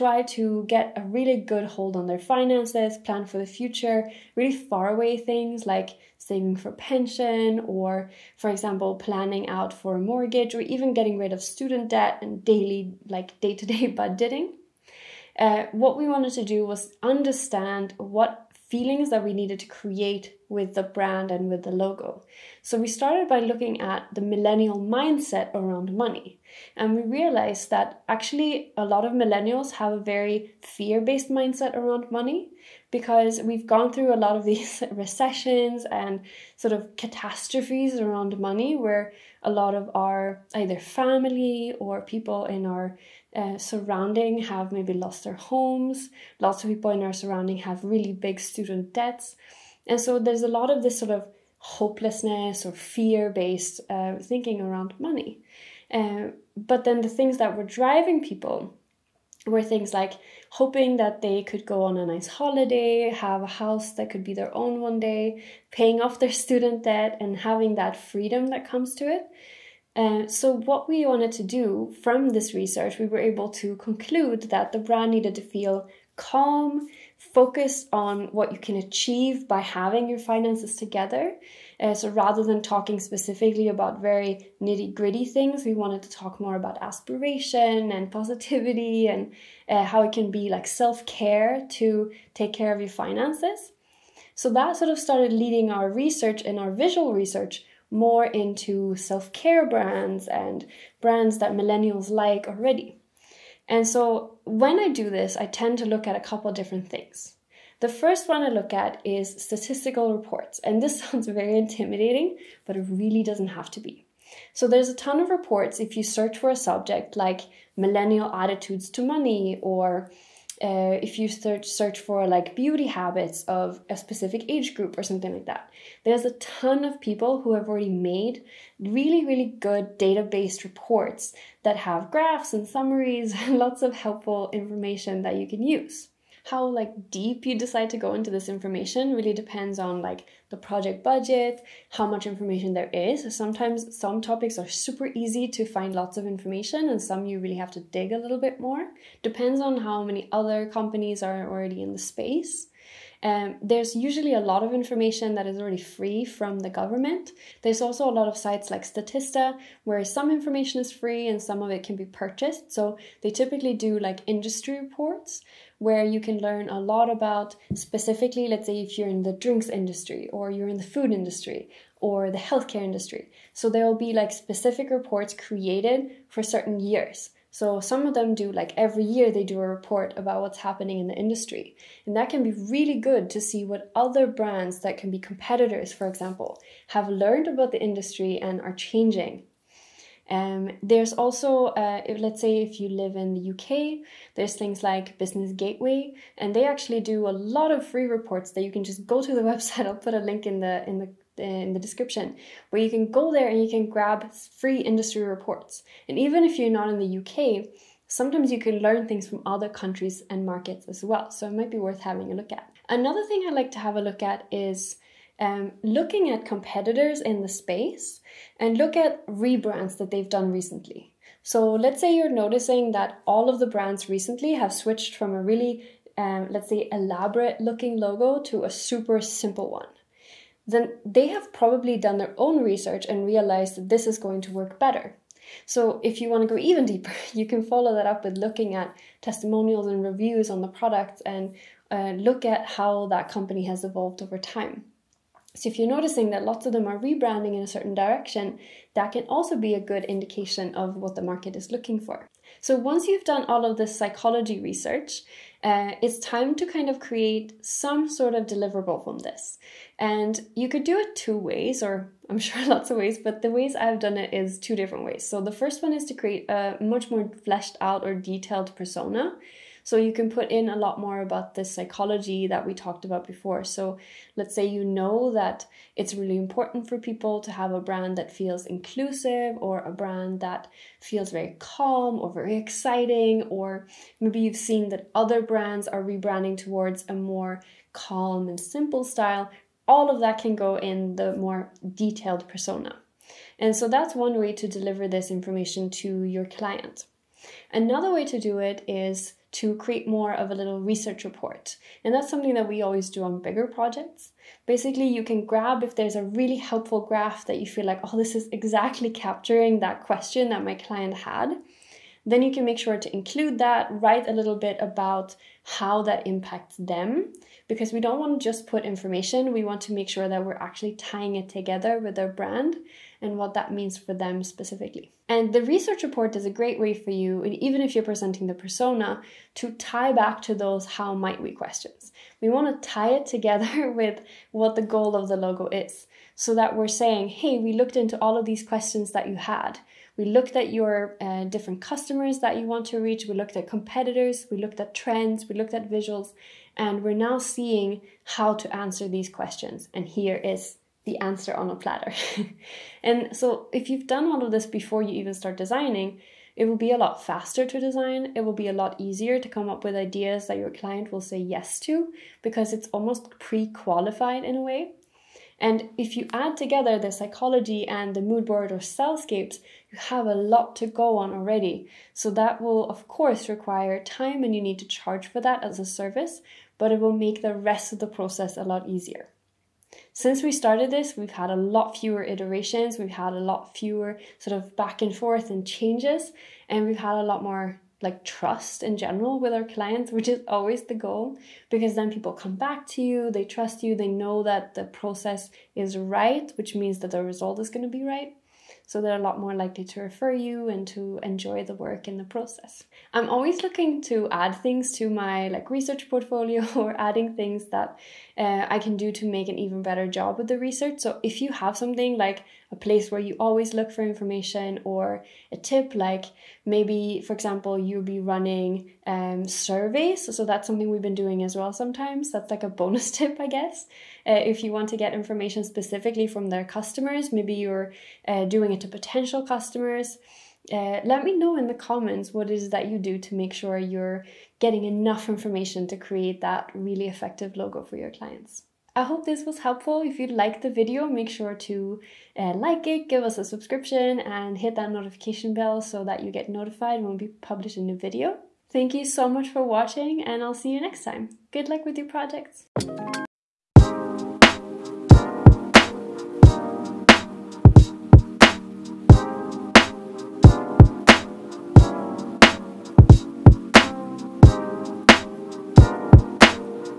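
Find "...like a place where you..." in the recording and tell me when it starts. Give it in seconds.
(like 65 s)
412 s.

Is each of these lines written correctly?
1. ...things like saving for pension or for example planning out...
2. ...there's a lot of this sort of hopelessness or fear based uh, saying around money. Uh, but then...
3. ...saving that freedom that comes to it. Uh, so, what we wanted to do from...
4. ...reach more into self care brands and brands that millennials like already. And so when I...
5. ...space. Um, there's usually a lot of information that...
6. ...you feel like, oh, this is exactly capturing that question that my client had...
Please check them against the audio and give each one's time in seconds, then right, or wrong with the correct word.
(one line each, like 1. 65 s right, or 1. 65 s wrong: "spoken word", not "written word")
1. 5 s right
2. 50 s wrong: "thinking", not "saying"
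3. 67 s wrong: "having", not "saving"
4. 97 s wrong: "research", not "reach"
5. 151 s right
6. 307 s right.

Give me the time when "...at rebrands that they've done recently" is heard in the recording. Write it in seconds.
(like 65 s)
218 s.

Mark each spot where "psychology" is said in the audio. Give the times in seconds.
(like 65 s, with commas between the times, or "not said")
253 s, 271 s, 367 s.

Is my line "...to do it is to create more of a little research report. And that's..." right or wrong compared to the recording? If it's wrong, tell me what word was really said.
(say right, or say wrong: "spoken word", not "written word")
right.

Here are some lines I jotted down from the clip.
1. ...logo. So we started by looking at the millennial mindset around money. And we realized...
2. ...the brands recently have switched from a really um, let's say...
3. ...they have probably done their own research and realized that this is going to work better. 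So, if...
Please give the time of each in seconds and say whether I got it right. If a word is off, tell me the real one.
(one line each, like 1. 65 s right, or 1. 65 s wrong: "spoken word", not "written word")
1. 21 s right
2. 223 s right
3. 231 s right.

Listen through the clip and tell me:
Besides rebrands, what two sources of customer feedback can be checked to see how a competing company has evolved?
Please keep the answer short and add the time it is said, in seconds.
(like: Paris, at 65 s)
Testimonials and reviews, at 239 s.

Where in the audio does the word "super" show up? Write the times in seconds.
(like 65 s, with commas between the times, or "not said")
144 s, 228 s.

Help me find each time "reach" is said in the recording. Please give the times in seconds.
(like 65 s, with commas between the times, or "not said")
342 s.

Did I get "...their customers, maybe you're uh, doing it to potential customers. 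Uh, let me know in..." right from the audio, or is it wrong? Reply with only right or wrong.
right.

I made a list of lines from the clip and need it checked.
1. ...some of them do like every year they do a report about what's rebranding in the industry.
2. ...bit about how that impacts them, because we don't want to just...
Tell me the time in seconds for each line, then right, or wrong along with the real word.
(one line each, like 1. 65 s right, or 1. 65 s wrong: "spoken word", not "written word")
1. 177 s wrong: "happening", not "rebranding"
2. 314 s right.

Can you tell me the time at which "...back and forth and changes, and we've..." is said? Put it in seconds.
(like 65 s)
384 s.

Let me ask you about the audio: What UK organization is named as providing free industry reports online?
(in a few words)
Business Gateway.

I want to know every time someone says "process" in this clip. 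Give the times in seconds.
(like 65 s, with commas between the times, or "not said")
378 s, 394 s, 402 s.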